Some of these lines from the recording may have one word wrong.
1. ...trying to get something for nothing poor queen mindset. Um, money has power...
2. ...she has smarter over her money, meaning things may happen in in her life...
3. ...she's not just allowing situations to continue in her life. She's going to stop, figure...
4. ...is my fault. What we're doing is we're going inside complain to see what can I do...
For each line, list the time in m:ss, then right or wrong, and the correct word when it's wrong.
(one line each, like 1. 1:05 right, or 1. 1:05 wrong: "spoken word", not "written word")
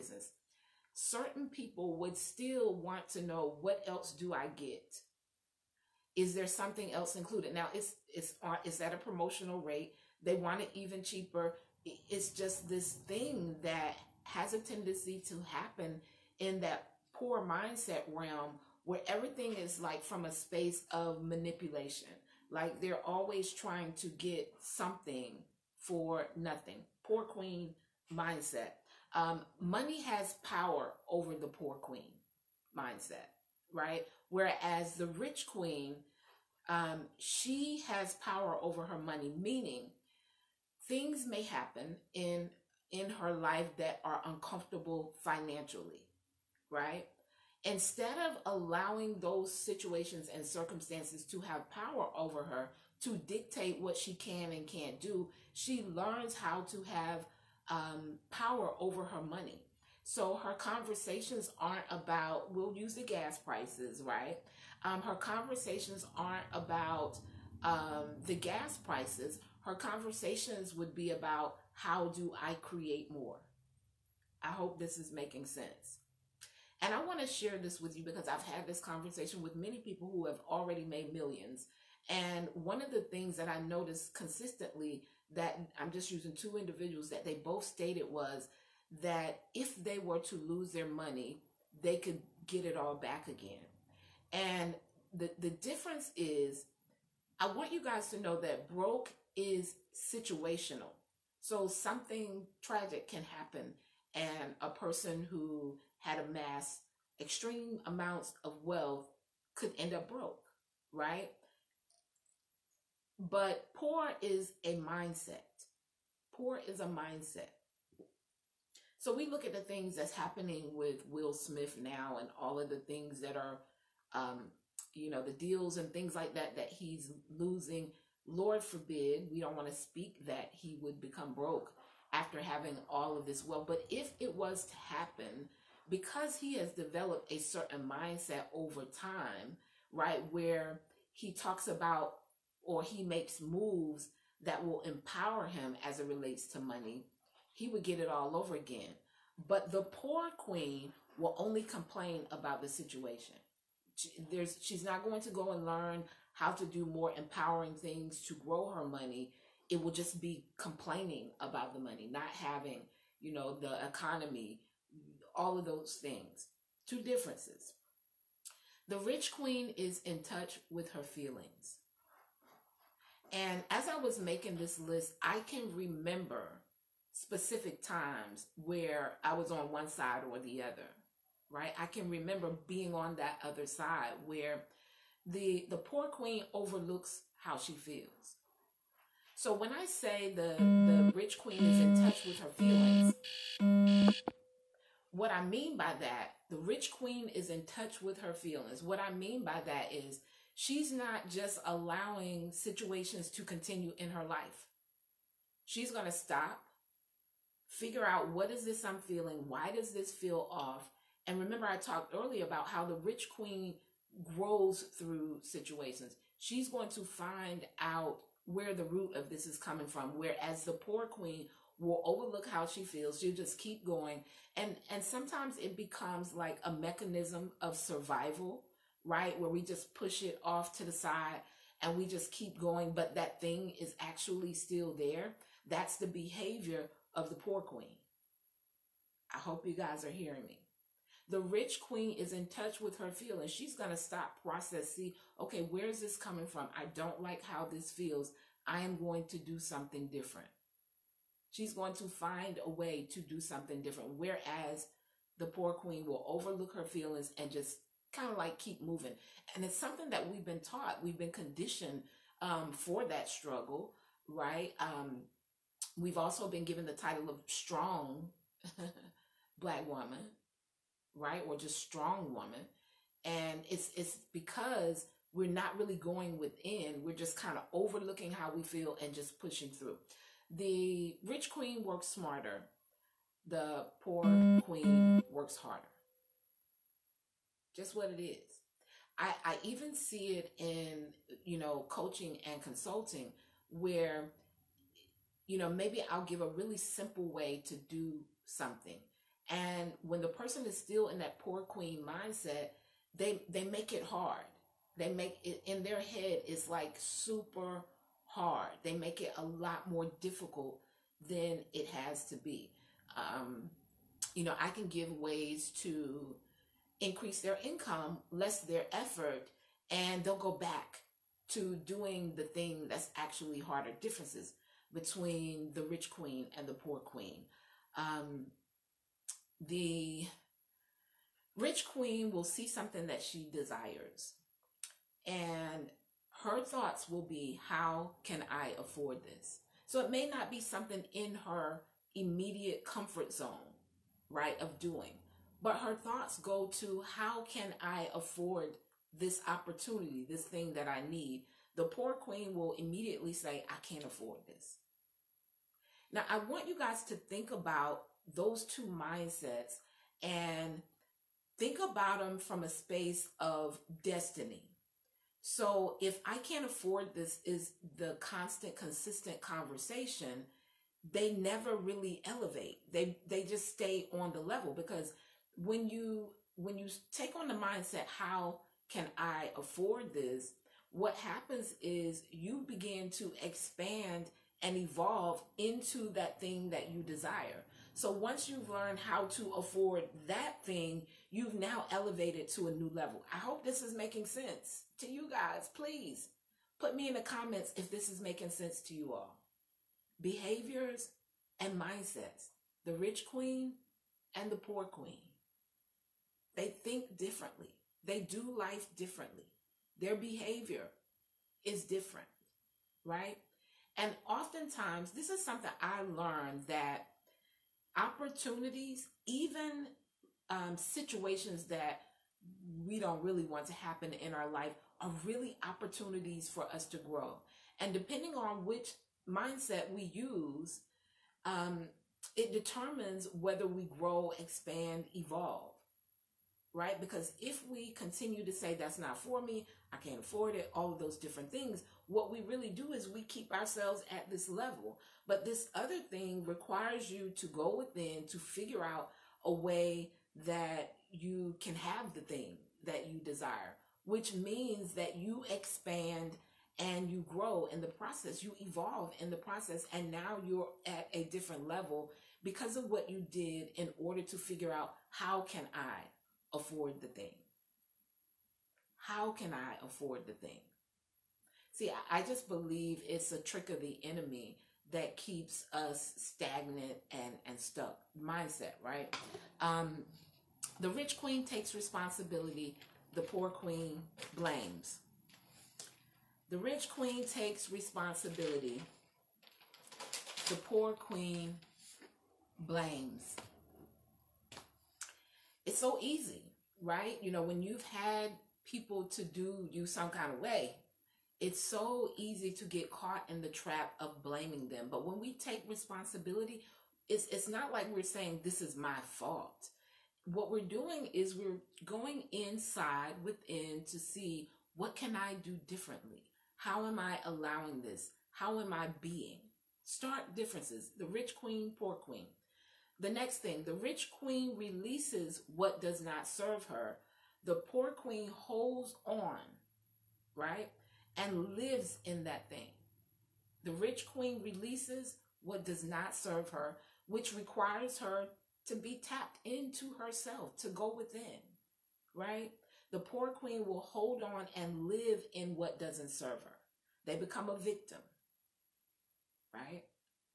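1. 0:23 right
2. 0:37 wrong: "power", not "smarter"
3. 3:20 right
4. 8:28 wrong: "within", not "complain".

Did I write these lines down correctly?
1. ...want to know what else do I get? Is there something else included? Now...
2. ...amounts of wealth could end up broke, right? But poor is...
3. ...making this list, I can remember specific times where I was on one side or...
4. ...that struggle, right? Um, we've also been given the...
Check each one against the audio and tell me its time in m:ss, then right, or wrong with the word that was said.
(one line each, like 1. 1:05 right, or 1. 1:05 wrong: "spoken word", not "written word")
1. 0:02 right
2. 1:47 right
3. 2:54 right
4. 4:23 right.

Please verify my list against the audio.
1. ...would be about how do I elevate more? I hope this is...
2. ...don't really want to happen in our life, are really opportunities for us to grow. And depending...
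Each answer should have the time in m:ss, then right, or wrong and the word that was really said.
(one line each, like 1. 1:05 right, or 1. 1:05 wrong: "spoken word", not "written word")
1. 1:10 wrong: "create", not "elevate"
2. 7:02 right.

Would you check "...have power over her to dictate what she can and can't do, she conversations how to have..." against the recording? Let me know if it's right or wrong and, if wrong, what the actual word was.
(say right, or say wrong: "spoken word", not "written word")
wrong: "learns", not "conversations".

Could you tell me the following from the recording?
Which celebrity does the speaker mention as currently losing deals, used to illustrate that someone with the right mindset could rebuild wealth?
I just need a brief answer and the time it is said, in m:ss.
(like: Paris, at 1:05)
Will Smith, at 2:01.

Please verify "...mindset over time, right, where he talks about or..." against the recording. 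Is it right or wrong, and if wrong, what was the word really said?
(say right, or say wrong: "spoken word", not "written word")
right.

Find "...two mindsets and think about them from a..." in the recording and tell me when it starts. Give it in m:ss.
5:58.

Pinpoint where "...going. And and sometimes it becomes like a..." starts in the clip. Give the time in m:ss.
3:43.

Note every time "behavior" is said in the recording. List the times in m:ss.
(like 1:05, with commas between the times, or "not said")
3:56, 6:40, 6:50.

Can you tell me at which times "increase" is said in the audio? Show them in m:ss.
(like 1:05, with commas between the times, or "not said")
5:17.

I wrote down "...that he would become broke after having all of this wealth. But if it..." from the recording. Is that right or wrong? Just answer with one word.
right.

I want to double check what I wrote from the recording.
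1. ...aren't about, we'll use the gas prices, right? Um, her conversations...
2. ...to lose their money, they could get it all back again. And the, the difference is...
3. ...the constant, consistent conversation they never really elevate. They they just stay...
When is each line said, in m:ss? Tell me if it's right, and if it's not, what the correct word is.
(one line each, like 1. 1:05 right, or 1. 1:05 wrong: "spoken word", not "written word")
1. 1:01 right
2. 1:30 right
3. 6:07 right.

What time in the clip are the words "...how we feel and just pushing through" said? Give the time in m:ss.
4:38.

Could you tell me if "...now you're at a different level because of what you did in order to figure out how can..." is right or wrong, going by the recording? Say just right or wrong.
right.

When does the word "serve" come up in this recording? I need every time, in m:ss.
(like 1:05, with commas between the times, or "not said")
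8:46, 8:56, 9:06.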